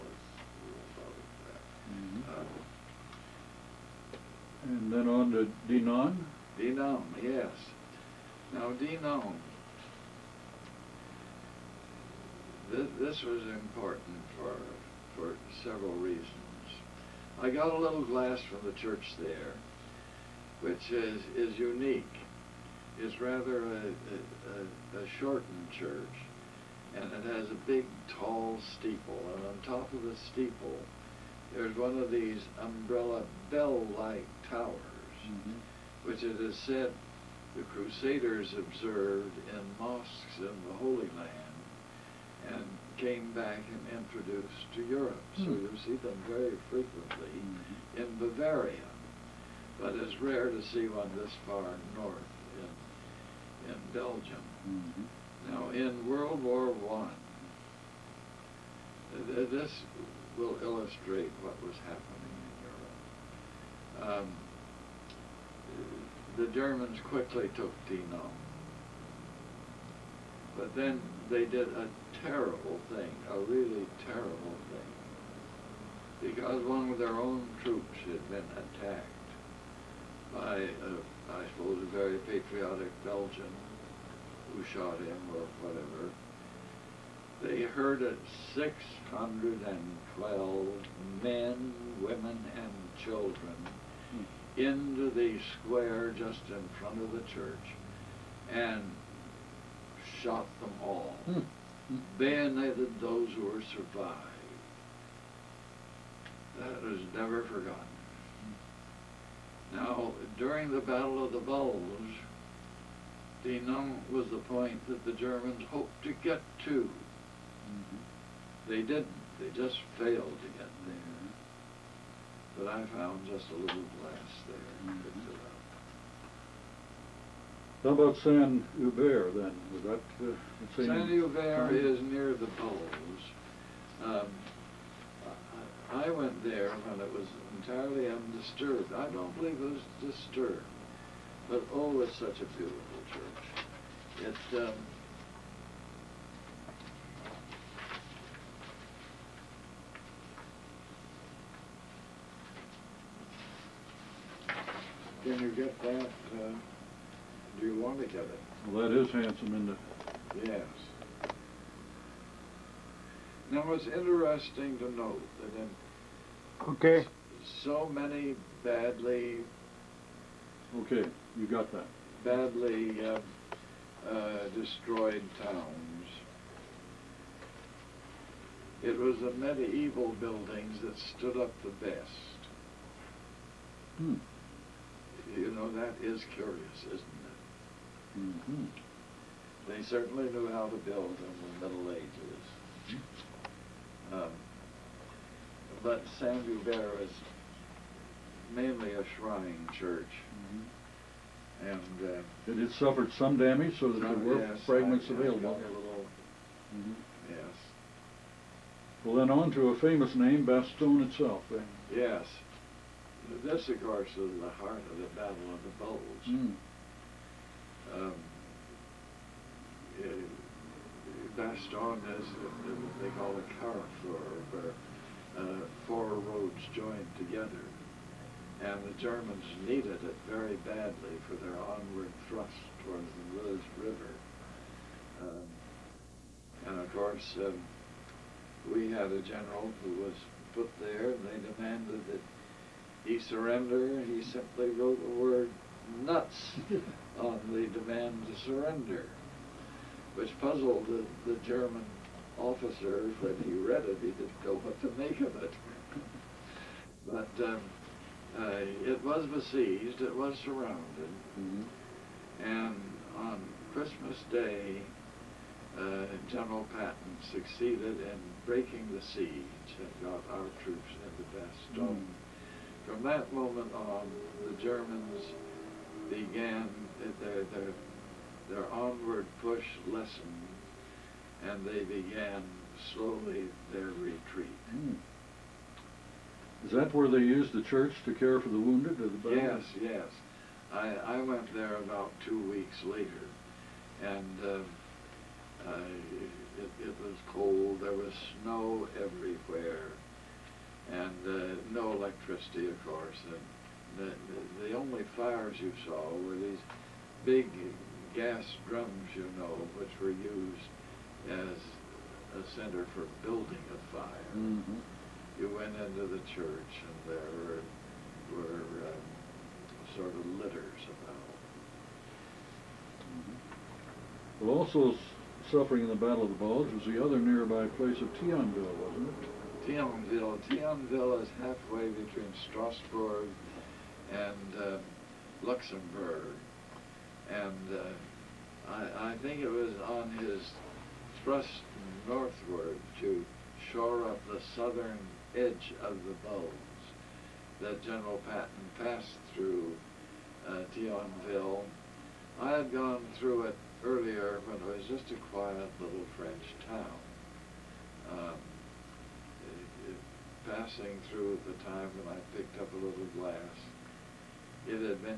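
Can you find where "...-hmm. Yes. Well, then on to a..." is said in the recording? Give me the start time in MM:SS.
03:26.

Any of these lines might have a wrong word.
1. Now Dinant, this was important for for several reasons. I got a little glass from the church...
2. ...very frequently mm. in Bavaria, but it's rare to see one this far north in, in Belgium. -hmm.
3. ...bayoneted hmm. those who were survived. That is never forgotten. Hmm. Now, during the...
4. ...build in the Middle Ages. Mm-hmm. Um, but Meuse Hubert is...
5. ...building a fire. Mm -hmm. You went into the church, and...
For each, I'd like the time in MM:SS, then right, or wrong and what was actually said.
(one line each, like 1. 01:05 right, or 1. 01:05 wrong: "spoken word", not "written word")
1. 00:08 right
2. 00:46 right
3. 01:42 right
4. 03:10 wrong: "Saint", not "Meuse"
5. 05:13 right.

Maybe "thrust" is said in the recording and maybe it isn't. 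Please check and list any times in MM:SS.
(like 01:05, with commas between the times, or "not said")
03:52, 05:41.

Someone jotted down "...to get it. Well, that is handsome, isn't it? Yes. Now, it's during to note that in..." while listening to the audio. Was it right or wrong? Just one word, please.
wrong.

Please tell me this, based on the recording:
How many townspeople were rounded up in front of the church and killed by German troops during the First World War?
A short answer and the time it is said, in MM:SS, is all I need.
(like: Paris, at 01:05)
612, at 01:28.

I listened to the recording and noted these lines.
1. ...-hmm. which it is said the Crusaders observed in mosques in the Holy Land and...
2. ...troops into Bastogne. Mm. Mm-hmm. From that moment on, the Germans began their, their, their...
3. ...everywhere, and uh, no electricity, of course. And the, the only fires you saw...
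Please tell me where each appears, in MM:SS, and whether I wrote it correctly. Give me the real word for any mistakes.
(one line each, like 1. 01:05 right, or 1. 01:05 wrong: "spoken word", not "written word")
1. 00:35 right
2. 04:30 right
3. 04:59 right.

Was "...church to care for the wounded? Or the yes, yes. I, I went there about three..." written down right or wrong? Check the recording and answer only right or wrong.
wrong.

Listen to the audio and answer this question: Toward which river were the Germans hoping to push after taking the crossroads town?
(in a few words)
Meuse River.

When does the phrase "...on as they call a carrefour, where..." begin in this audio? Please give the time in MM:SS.
03:41.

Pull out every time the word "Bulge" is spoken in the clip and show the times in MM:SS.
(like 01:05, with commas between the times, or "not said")
01:51, 03:35, 05:26, 05:46.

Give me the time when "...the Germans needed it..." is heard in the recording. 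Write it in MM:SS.
03:48.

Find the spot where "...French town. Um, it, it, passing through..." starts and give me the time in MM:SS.
05:56.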